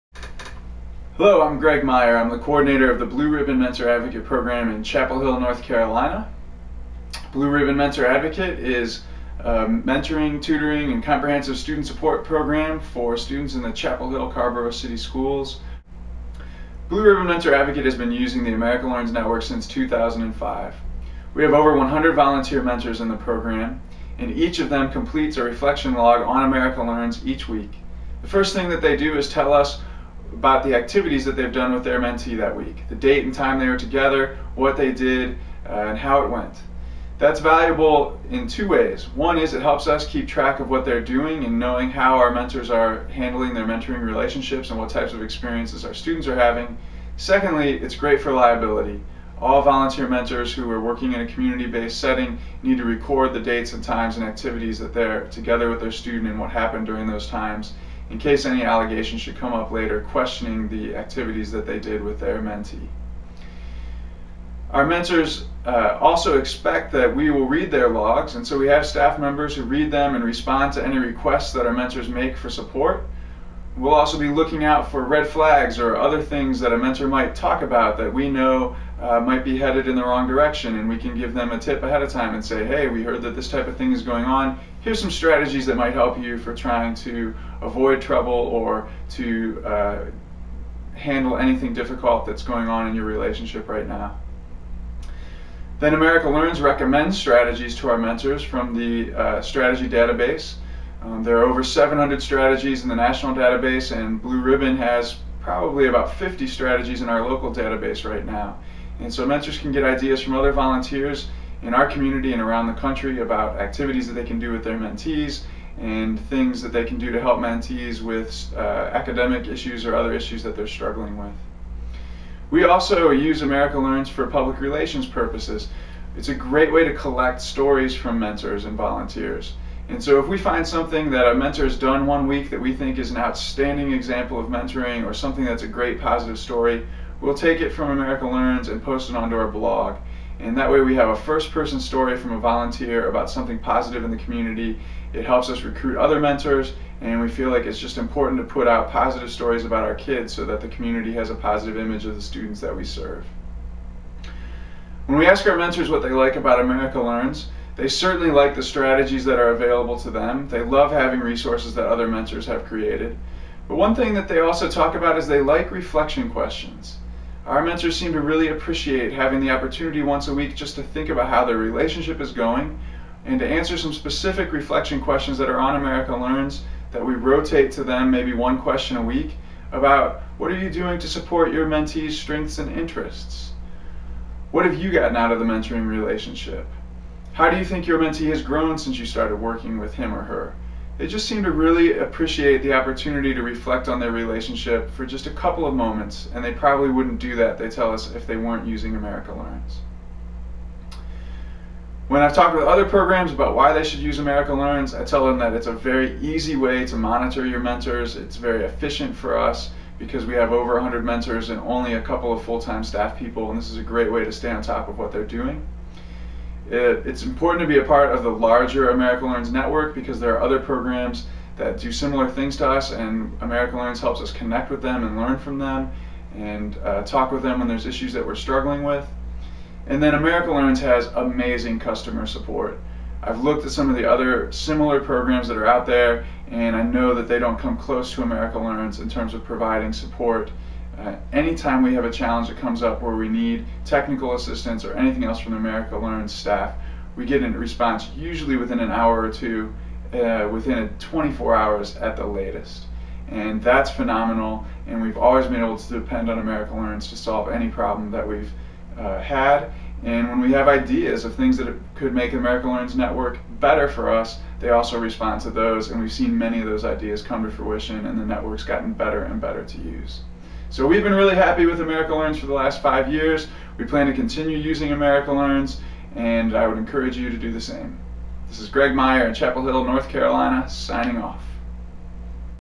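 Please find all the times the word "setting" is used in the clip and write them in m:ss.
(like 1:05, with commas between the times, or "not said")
0:51.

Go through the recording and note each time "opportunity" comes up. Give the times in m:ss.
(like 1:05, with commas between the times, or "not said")
2:49, 3:12.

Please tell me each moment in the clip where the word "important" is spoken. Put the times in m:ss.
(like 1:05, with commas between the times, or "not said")
2:27, 3:37.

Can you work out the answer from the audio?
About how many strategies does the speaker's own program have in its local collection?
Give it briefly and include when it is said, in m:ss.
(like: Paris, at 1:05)
50, at 1:46.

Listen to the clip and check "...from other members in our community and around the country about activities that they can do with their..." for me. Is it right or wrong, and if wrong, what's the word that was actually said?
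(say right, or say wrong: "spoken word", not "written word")
wrong: "volunteers", not "members".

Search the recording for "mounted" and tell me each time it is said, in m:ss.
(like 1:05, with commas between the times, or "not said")
not said.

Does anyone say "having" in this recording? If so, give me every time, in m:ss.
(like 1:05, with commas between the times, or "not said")
0:46, 2:40, 2:49.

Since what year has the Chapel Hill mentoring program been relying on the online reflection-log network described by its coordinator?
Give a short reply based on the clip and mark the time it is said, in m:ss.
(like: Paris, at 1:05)
2005, at 0:19.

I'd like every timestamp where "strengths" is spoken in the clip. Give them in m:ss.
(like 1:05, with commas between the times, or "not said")
3:02.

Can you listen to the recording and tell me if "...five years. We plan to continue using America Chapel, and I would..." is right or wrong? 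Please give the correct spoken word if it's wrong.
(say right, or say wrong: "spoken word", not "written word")
wrong: "Learns", not "Chapel".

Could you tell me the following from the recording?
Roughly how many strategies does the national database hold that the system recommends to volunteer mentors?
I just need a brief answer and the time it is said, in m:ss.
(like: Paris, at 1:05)
700, at 1:41.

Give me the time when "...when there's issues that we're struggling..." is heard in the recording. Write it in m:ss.
3:47.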